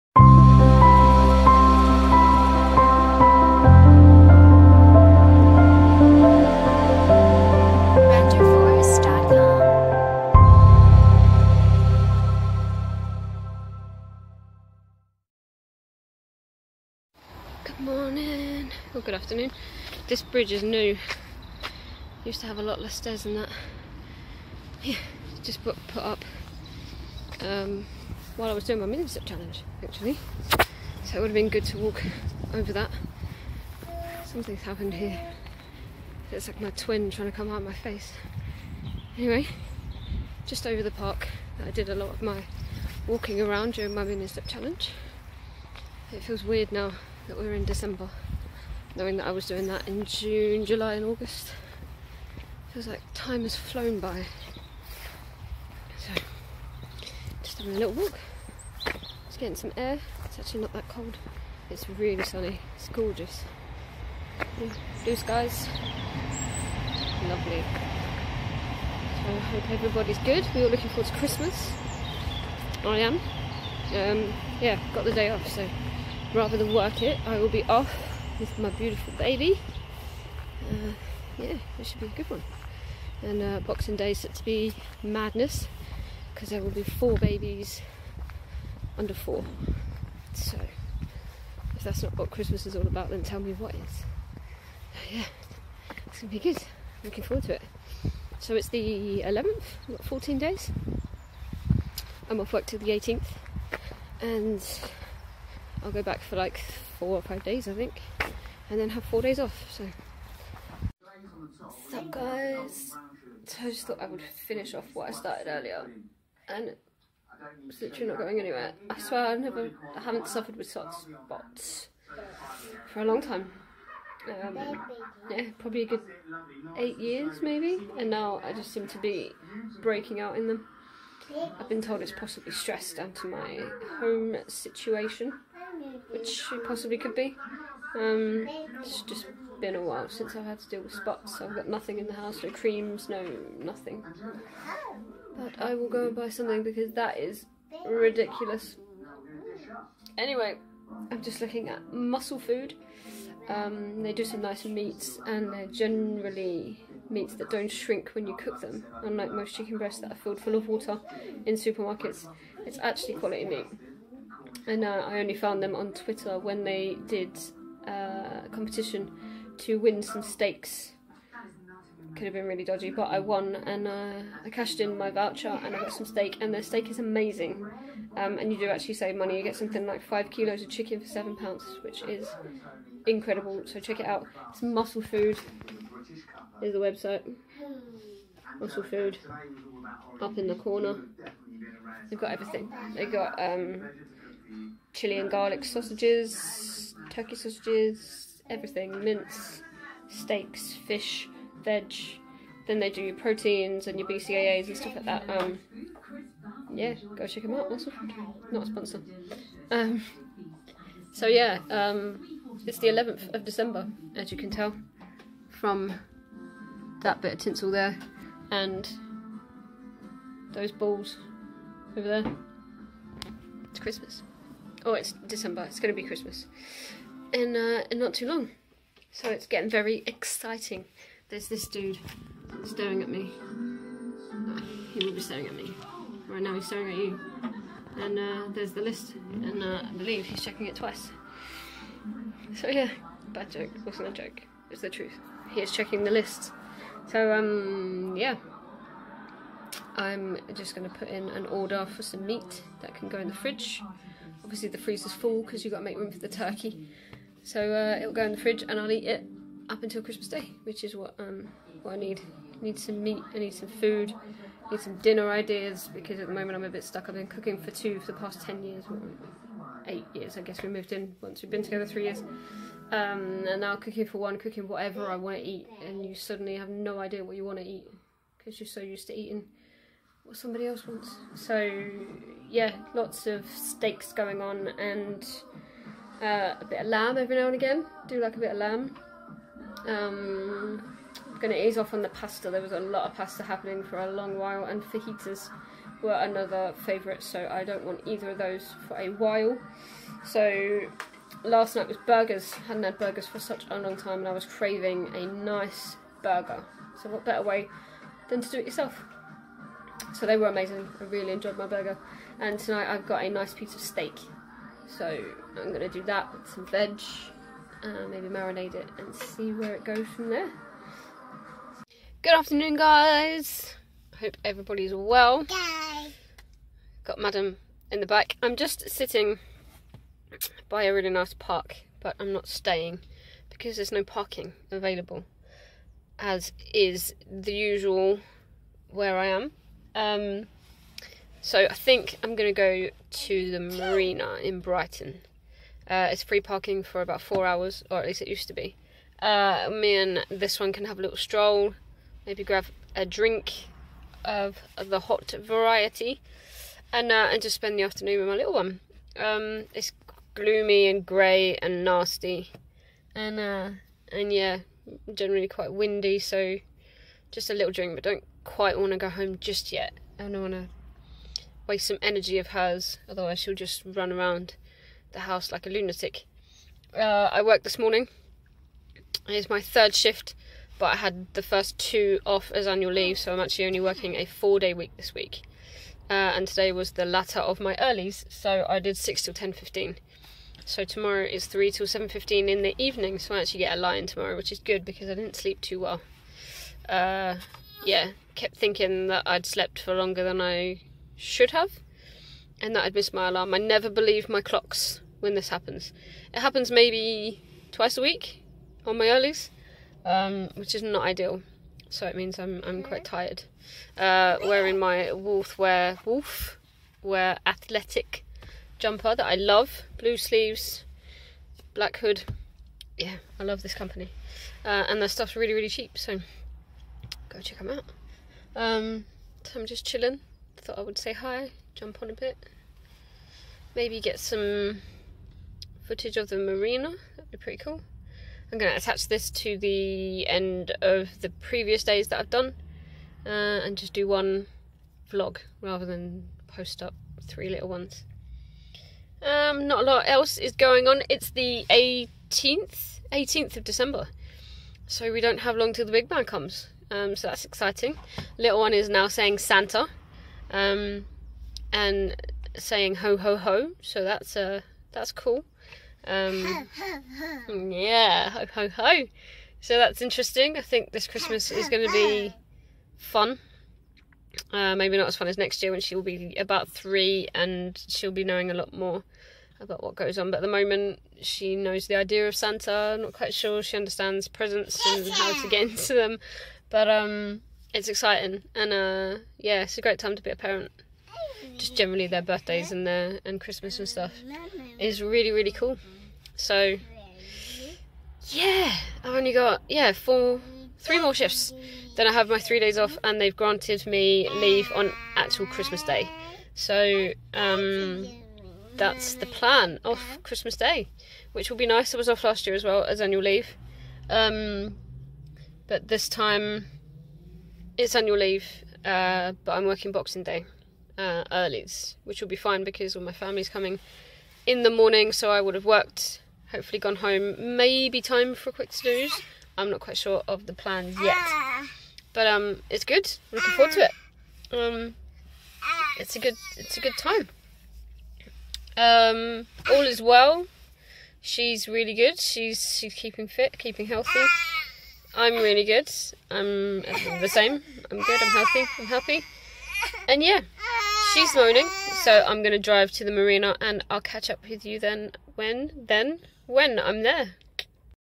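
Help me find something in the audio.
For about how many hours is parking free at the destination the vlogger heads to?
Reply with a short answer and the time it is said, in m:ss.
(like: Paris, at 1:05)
4, at 5:47.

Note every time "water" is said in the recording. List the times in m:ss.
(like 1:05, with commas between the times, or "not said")
2:40.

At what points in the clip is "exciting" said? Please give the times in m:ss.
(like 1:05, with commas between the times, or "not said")
3:50, 7:37, 8:07.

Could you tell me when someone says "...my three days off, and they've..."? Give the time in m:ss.
8:22.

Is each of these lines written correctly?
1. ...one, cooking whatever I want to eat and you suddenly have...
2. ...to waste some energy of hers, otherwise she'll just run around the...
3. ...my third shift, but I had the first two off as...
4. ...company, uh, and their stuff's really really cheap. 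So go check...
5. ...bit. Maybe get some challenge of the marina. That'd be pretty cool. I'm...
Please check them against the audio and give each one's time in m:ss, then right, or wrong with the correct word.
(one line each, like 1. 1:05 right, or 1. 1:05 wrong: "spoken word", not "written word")
1. 4:34 right
2. 6:10 right
3. 6:19 right
4. 7:03 right
5. 7:12 wrong: "footage", not "challenge".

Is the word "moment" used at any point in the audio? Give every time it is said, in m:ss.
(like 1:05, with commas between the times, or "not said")
4:26, 8:00.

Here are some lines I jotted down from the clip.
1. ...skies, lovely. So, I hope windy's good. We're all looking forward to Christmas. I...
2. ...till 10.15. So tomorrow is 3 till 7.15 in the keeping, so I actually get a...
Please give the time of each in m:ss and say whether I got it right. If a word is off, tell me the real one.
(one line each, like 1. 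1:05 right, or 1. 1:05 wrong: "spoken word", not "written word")
1. 1:05 wrong: "everybody", not "windy"
2. 6:29 wrong: "evening", not "keeping".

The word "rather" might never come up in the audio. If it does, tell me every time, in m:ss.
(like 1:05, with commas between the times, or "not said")
1:16, 7:25.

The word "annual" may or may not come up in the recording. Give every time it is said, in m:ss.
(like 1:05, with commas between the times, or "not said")
6:22, 8:33, 8:37.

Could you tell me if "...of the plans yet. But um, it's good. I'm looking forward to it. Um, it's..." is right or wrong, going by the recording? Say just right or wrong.
right.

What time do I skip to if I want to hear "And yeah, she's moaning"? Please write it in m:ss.
9:10.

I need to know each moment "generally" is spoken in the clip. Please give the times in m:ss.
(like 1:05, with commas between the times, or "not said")
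2:35, 6:05, 8:11.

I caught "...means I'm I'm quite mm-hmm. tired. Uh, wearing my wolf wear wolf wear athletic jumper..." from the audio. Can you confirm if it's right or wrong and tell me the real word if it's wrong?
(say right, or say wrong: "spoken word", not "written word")
right.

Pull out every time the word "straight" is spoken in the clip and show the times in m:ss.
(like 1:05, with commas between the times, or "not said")
not said.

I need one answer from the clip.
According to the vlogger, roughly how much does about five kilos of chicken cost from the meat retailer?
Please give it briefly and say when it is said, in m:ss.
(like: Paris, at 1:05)
£7, at 3:01.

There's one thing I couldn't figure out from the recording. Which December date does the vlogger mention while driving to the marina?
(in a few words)
18 December.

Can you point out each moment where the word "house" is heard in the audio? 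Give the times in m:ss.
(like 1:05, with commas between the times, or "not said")
2:22, 6:15.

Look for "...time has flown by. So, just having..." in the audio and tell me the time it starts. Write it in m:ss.
0:53.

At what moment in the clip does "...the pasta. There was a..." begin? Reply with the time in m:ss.
4:52.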